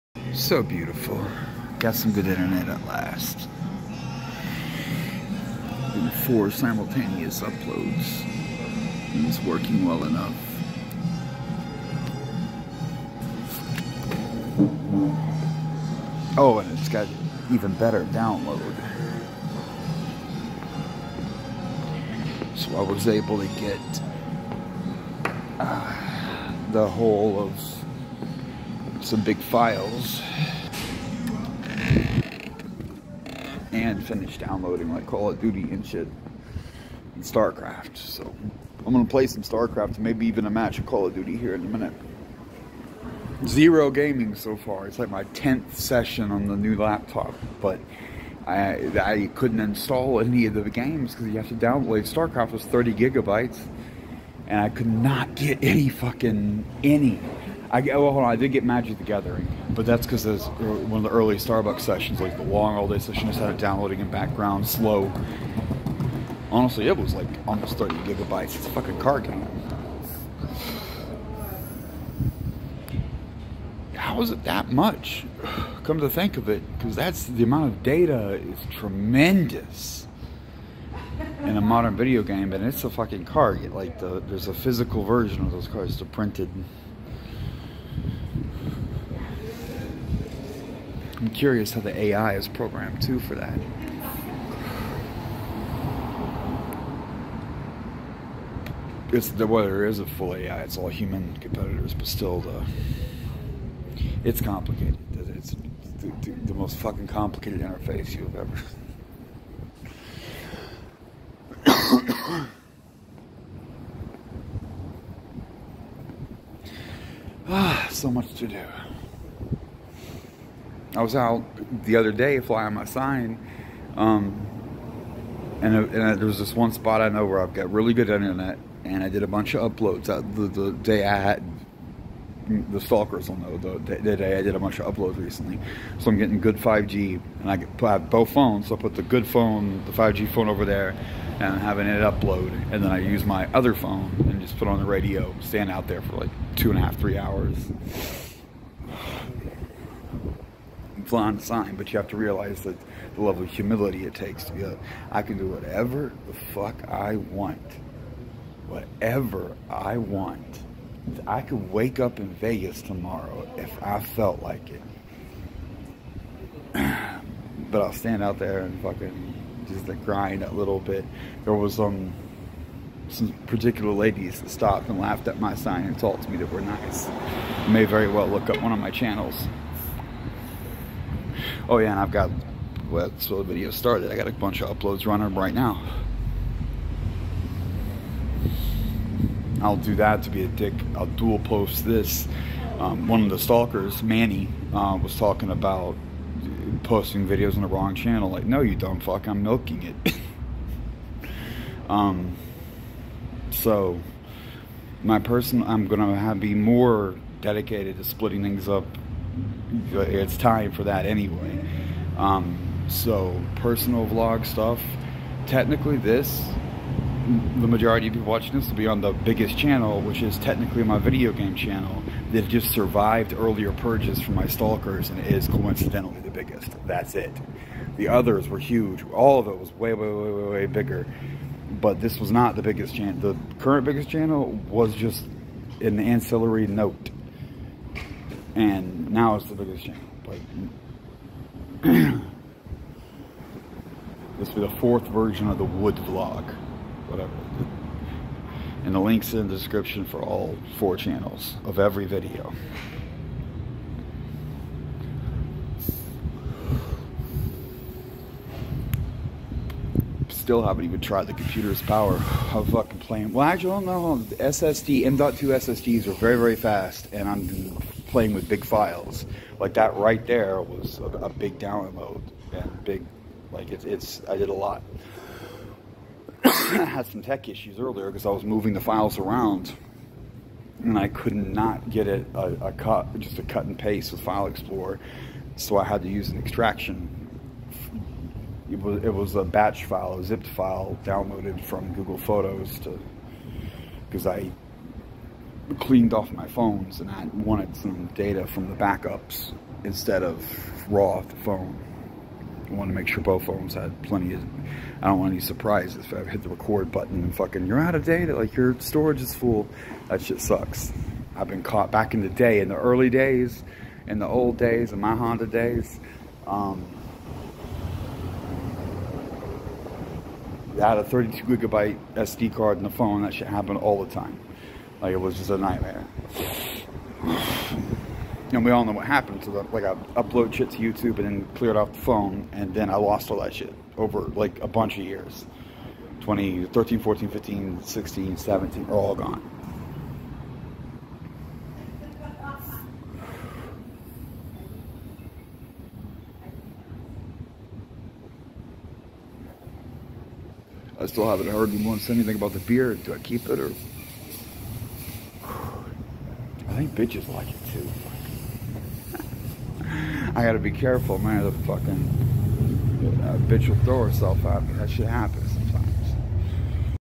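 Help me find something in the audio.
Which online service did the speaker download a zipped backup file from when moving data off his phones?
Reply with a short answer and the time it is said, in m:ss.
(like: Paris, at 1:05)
Google Photos, at 4:51.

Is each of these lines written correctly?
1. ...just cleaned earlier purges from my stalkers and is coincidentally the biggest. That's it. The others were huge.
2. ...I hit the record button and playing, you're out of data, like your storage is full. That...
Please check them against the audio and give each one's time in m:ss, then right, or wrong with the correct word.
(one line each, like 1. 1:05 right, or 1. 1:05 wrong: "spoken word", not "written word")
1. 3:42 wrong: "survived", not "cleaned"
2. 5:06 wrong: "fucking", not "playing".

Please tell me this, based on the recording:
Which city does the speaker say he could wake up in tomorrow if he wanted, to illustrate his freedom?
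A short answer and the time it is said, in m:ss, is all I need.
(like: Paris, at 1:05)
Vegas, at 2:42.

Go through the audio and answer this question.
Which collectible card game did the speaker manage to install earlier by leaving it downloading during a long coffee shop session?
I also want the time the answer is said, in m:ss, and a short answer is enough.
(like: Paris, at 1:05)
Magic the Gathering, at 0:58.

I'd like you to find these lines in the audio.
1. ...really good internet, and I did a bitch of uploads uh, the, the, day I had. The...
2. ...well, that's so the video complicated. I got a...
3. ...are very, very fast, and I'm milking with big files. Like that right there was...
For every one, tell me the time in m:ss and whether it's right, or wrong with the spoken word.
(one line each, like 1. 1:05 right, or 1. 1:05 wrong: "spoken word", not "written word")
1. 2:07 wrong: "bunch", not "bitch"
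2. 3:02 wrong: "started", not "complicated"
3. 4:26 wrong: "playing", not "milking".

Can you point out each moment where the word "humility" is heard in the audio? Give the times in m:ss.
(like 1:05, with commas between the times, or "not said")
2:33.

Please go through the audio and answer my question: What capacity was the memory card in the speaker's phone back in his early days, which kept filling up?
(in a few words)
32 gigabytes.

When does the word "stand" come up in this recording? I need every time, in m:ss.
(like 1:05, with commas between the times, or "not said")
2:25, 2:47.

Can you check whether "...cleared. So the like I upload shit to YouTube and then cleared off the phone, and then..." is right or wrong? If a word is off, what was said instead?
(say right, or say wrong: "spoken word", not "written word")
wrong: "happened", not "cleared".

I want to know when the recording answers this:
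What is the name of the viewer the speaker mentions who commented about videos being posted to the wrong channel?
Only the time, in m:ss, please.
3:14.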